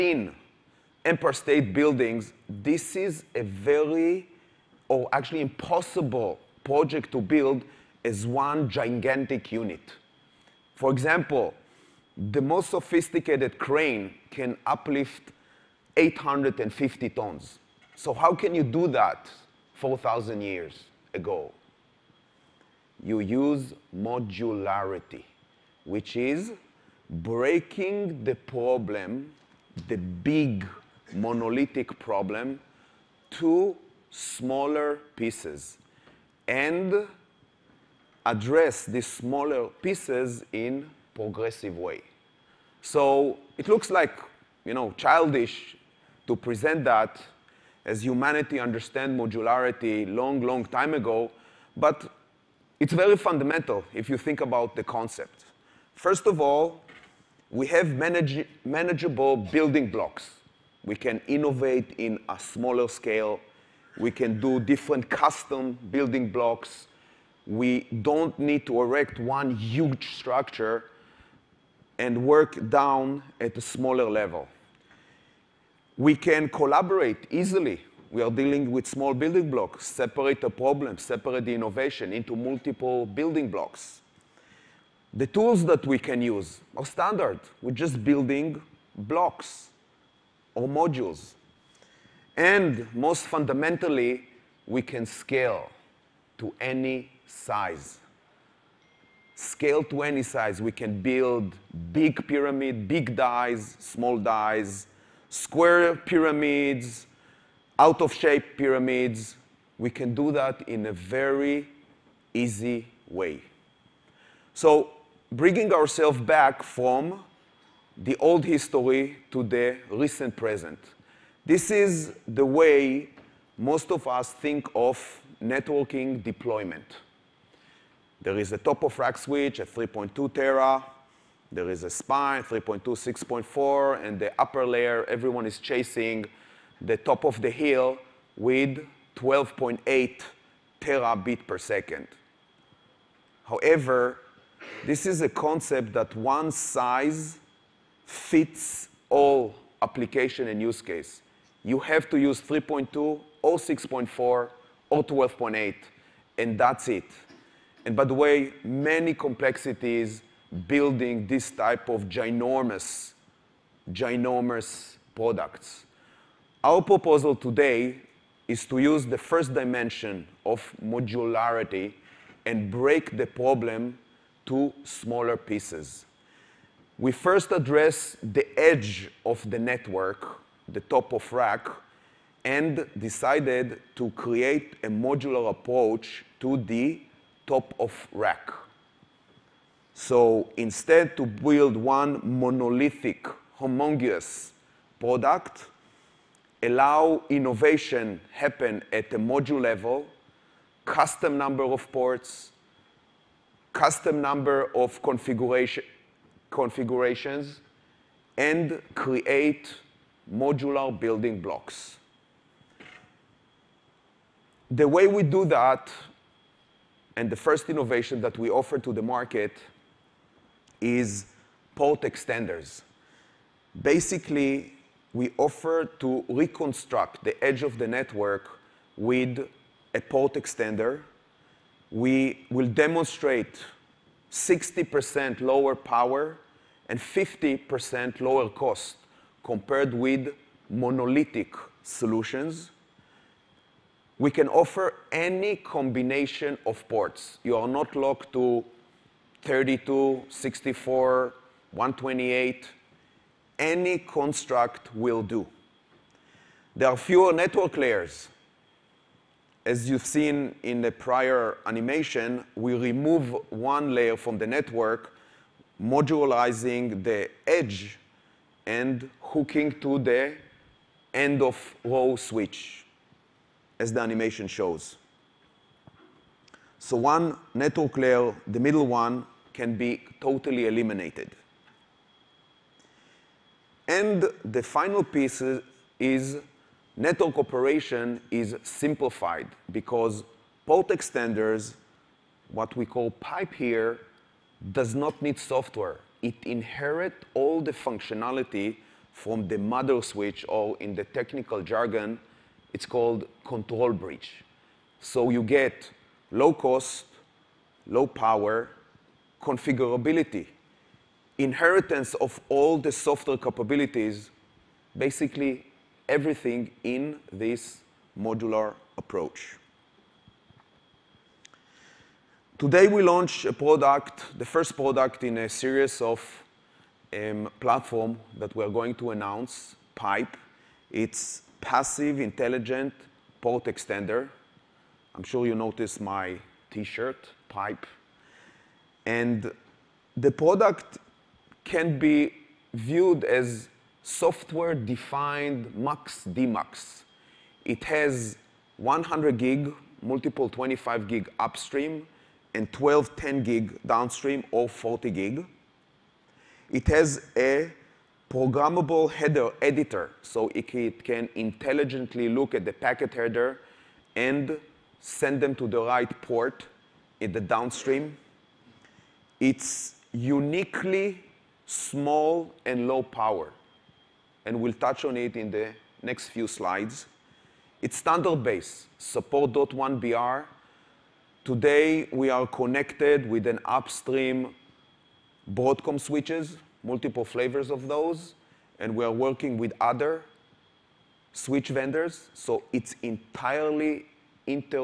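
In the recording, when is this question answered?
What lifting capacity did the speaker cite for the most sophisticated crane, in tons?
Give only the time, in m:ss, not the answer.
0:15.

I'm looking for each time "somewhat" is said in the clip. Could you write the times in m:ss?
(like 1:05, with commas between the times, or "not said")
not said.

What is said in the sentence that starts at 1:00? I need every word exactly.
We can innovate in a smaller scale.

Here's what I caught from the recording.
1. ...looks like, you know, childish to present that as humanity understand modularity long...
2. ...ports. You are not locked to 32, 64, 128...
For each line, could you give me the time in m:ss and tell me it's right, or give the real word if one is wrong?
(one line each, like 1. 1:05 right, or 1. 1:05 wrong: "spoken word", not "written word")
1. 0:43 right
2. 4:06 right.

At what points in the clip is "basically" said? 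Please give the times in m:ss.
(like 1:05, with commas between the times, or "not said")
3:43, 5:14.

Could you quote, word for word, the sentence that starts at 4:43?
And the final piece is network operation is simplified because port extenders, what we call pipe here, does not need software.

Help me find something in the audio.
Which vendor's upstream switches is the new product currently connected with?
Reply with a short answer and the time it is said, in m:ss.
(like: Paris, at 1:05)
Broadcom, at 6:25.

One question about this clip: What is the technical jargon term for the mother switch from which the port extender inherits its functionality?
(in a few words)
control bridge.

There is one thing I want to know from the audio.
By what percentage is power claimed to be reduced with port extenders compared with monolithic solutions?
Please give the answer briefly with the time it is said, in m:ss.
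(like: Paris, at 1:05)
60%, at 3:54.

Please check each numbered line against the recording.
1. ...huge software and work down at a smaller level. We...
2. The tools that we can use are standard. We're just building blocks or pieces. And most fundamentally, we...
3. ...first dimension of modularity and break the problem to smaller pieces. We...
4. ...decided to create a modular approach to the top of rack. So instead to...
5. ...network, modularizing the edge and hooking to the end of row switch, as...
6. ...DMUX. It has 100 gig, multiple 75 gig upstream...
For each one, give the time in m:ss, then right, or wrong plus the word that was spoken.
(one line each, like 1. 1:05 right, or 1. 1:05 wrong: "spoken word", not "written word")
1. 1:09 wrong: "structure", not "software"
2. 1:25 wrong: "modules", not "pieces"
3. 2:49 right
4. 3:02 right
5. 4:24 right
6. 5:46 wrong: "25", not "75".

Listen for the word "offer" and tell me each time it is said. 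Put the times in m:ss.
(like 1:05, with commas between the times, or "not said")
3:38, 3:45, 4:04.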